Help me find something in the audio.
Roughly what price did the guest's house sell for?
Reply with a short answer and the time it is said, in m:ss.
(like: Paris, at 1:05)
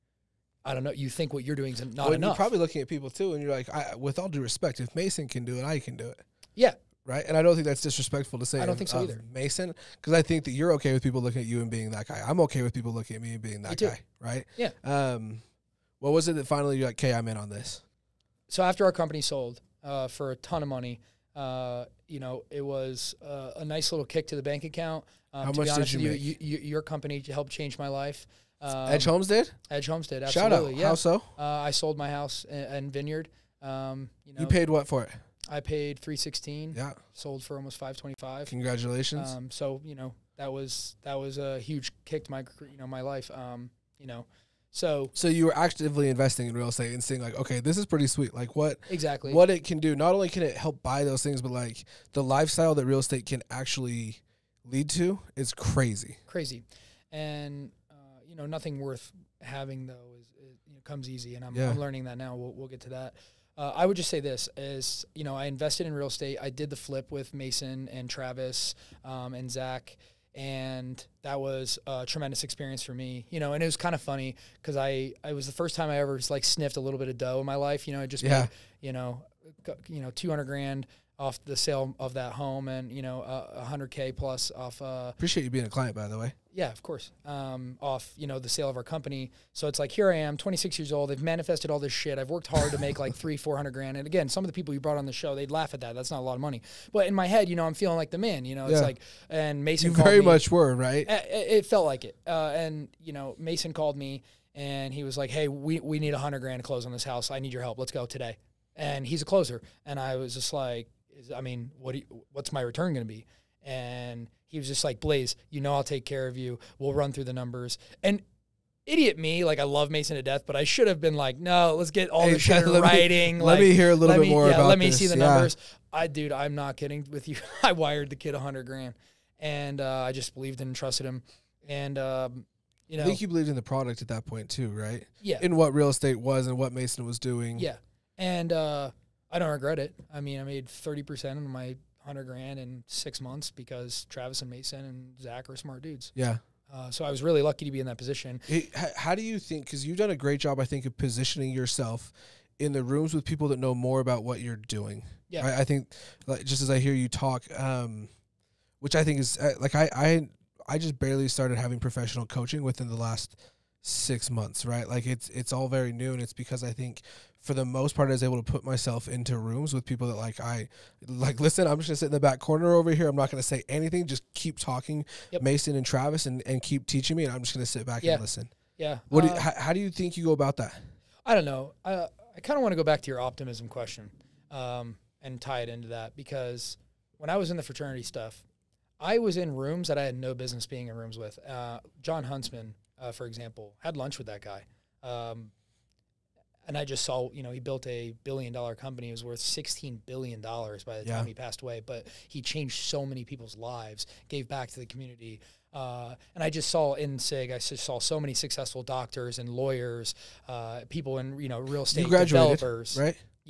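525, at 0:37.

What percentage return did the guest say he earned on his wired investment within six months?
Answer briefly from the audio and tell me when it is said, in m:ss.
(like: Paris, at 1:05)
30%, at 2:20.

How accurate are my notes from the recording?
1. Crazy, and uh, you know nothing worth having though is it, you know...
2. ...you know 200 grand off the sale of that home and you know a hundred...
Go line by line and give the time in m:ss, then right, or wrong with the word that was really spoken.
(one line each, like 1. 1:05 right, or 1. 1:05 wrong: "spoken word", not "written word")
1. 0:56 right
2. 1:19 right.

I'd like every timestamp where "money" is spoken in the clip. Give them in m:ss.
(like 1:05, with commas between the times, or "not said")
0:20, 1:36.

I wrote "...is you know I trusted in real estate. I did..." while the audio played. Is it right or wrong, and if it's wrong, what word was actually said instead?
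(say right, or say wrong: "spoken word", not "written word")
wrong: "invested", not "trusted".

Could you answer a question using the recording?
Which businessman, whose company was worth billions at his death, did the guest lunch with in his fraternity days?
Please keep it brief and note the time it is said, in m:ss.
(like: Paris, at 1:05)
Jon Huntsman, at 3:12.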